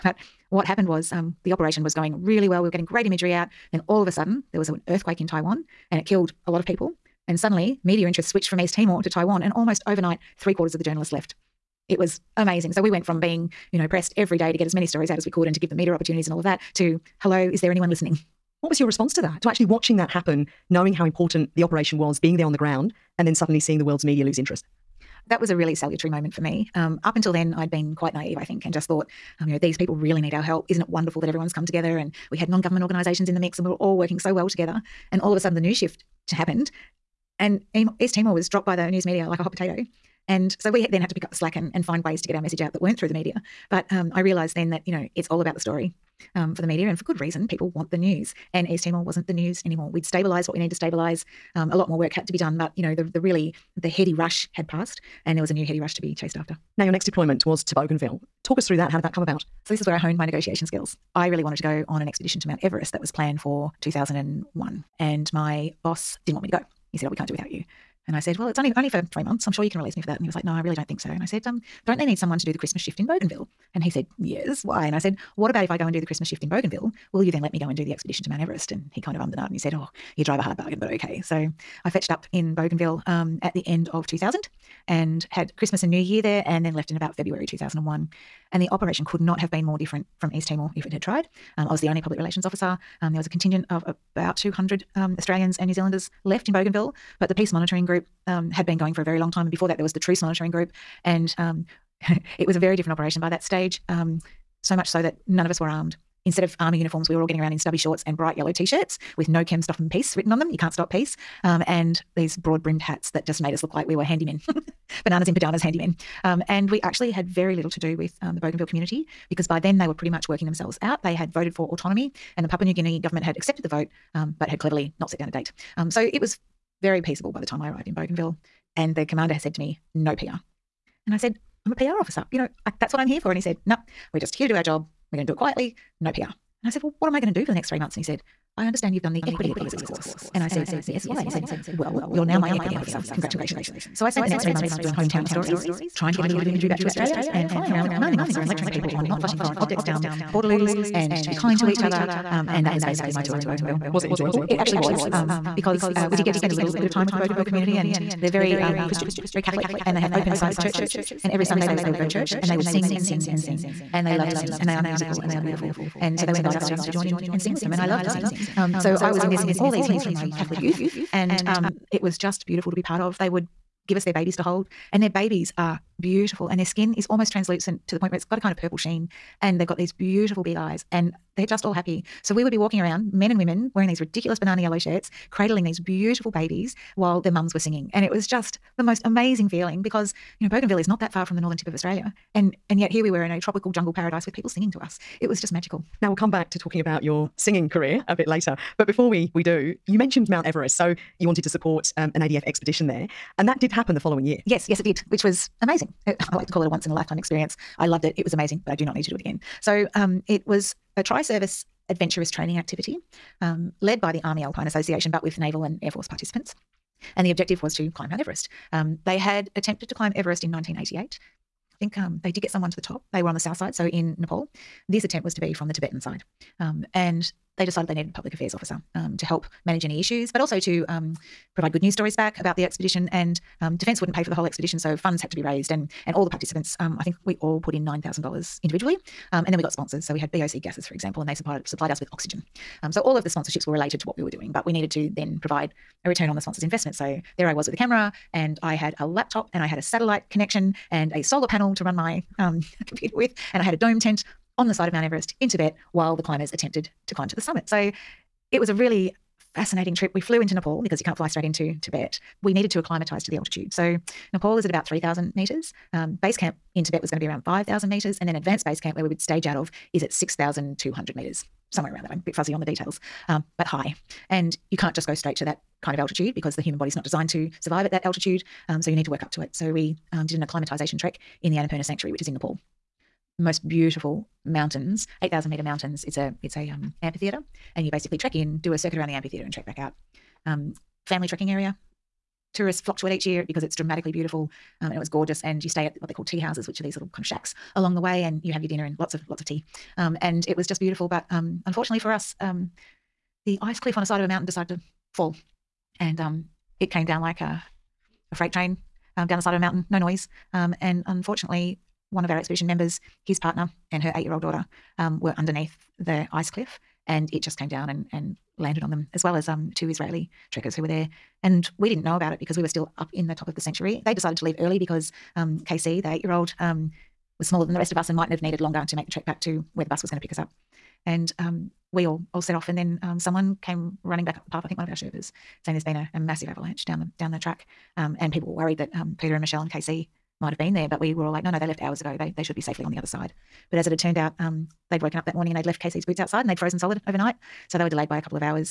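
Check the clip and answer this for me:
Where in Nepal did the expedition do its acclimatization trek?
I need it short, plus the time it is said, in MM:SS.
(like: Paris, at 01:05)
Annapurna Sanctuary, at 04:41.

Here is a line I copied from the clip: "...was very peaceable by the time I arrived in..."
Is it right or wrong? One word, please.
right.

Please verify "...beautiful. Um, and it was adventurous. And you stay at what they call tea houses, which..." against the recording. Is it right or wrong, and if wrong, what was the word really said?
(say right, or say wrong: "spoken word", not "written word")
wrong: "gorgeous", not "adventurous".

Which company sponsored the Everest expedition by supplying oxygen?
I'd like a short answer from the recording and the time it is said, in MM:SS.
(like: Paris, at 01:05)
BOC Gases, at 04:00.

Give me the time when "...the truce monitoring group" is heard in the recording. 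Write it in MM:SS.
01:39.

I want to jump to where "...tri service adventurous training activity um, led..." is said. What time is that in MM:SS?
03:31.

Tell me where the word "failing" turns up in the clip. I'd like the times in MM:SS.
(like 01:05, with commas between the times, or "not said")
not said.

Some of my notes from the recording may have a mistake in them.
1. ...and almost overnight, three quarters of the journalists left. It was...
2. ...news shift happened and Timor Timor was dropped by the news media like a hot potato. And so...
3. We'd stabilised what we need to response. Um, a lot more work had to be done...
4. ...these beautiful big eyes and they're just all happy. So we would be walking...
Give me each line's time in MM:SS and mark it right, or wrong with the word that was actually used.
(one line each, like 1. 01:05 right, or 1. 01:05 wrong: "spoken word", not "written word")
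1. 00:09 right
2. 00:35 wrong: "East", not "Timor"
3. 00:49 wrong: "stabilise", not "response"
4. 02:59 right.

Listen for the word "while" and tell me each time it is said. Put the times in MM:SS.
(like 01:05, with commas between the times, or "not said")
03:06, 04:15.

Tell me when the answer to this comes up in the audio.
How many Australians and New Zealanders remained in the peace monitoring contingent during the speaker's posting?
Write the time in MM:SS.
01:34.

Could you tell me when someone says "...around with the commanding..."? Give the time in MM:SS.
02:27.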